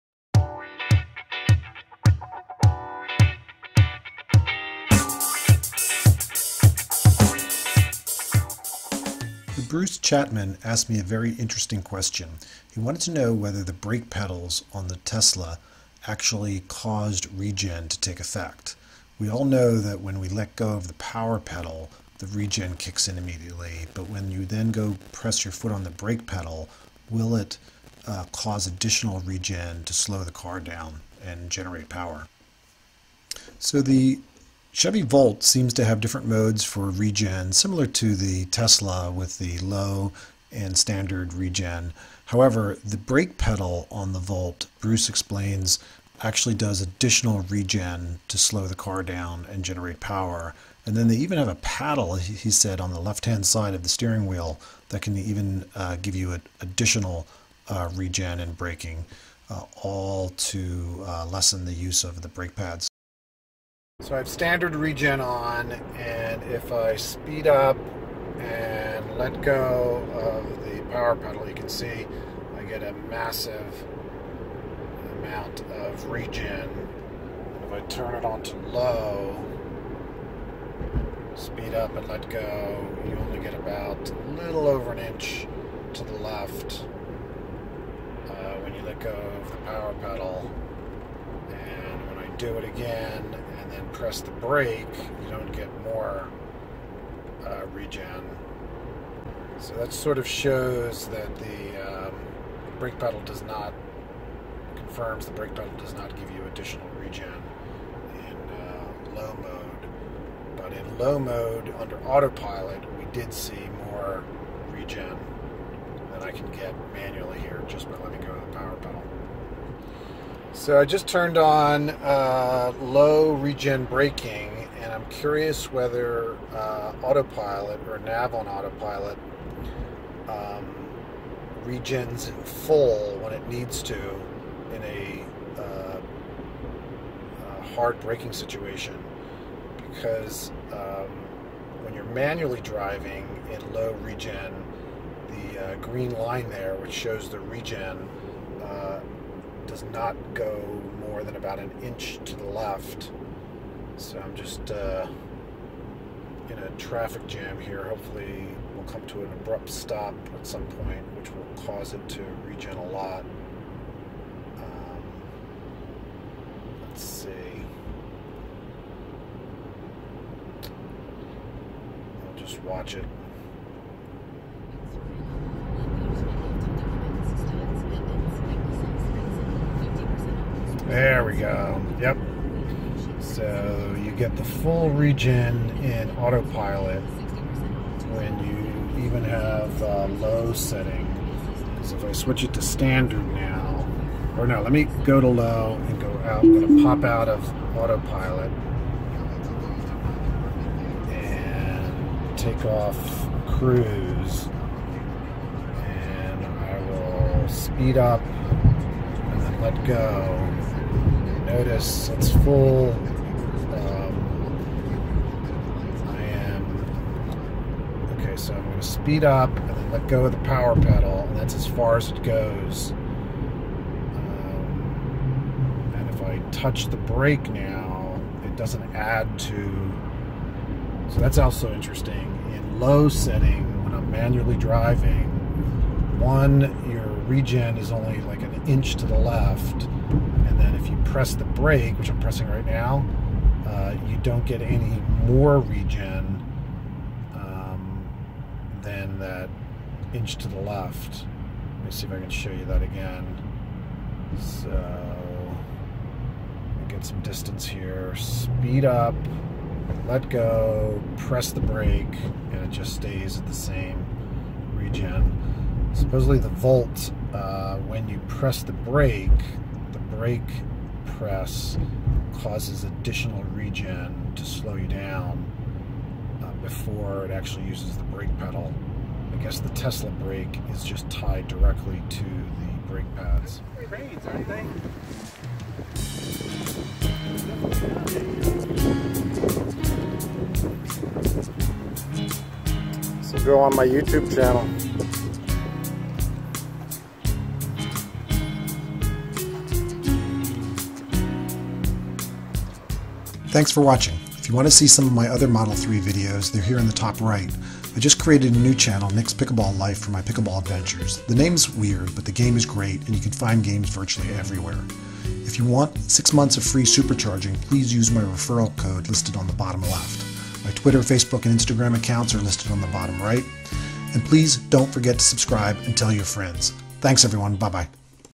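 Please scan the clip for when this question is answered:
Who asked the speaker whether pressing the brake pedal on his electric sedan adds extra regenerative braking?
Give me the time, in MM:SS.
00:09.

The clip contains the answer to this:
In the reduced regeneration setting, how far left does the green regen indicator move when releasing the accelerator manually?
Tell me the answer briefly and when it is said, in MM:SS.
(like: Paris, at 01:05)
a little over an inch, at 01:24.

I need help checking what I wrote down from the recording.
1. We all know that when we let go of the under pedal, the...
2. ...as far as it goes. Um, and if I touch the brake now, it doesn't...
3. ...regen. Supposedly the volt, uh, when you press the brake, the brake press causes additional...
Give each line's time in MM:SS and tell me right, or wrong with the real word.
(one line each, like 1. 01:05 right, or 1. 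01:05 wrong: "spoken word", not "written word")
1. 00:19 wrong: "power", not "under"
2. 03:41 right
3. 04:24 right.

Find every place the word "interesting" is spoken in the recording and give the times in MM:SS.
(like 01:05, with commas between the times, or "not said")
00:11, 03:51.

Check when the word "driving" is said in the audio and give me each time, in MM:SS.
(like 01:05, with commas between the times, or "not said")
02:22, 03:54.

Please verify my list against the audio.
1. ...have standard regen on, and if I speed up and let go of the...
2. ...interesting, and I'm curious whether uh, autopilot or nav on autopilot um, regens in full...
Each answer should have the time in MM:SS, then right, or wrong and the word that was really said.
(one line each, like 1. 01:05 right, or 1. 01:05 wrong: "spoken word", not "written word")
1. 01:04 right
2. 02:03 wrong: "braking", not "interesting".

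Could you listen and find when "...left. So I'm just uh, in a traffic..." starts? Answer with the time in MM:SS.
02:32.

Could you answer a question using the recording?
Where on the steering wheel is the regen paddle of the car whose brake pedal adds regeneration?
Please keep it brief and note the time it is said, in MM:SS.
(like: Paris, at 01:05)
left-hand side, at 00:53.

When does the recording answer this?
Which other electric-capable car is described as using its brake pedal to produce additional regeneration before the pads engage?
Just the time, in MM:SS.
00:34.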